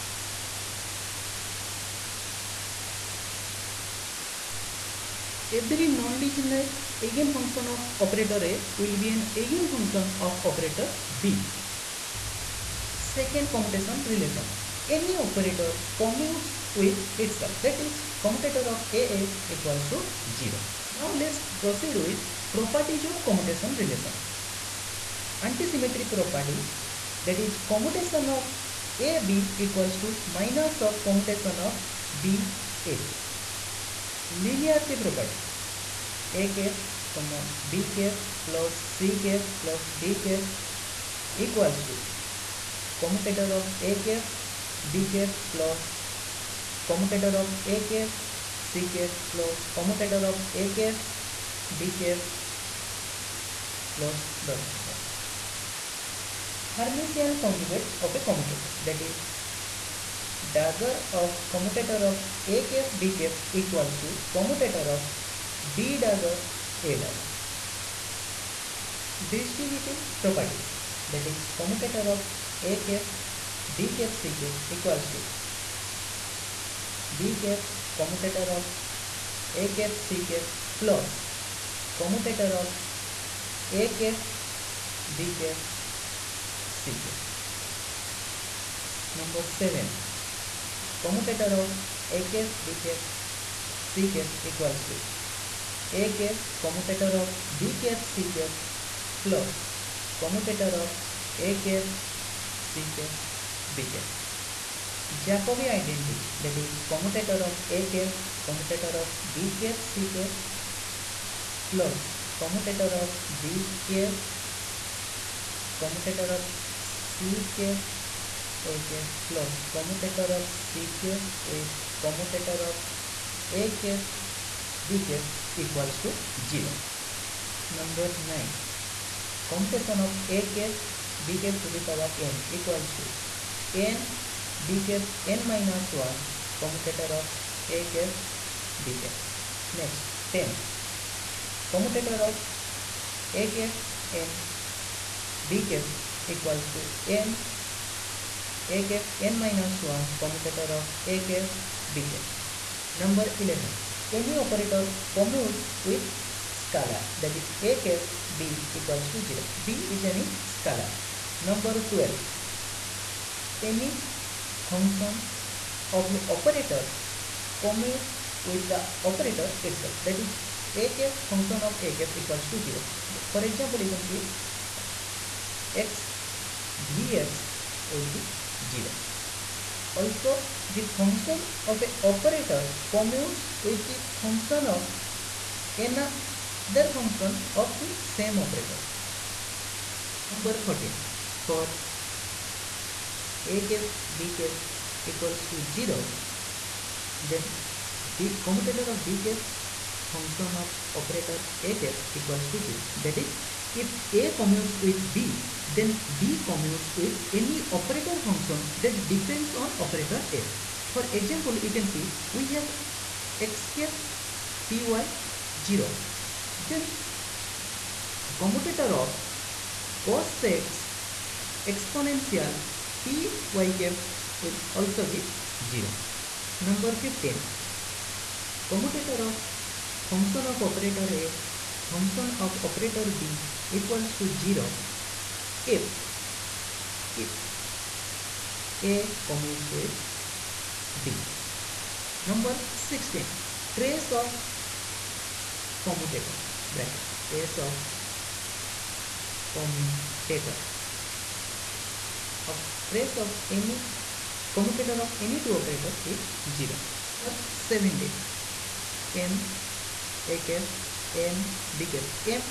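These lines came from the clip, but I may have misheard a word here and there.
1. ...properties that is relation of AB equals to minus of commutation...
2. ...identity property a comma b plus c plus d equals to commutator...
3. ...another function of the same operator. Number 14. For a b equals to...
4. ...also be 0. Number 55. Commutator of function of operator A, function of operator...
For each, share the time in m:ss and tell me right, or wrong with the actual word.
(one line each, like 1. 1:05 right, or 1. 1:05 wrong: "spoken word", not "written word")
1. 0:26 wrong: "commutation", not "relation"
2. 0:34 wrong: "linearity", not "identity"
3. 3:05 right
4. 3:44 wrong: "15", not "55".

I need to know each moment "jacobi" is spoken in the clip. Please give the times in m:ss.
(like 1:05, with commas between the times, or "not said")
1:45.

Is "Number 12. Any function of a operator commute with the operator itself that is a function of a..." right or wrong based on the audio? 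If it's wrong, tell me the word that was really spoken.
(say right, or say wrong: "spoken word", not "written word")
right.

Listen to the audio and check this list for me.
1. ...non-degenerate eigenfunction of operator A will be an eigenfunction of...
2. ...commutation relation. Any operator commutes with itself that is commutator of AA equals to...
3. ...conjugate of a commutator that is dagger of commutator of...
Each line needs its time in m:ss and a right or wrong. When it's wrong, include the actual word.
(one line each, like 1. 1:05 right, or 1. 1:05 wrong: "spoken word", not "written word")
1. 0:05 right
2. 0:13 right
3. 0:57 right.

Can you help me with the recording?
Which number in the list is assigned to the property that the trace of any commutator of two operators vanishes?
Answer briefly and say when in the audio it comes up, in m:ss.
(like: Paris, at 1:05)
16, at 4:02.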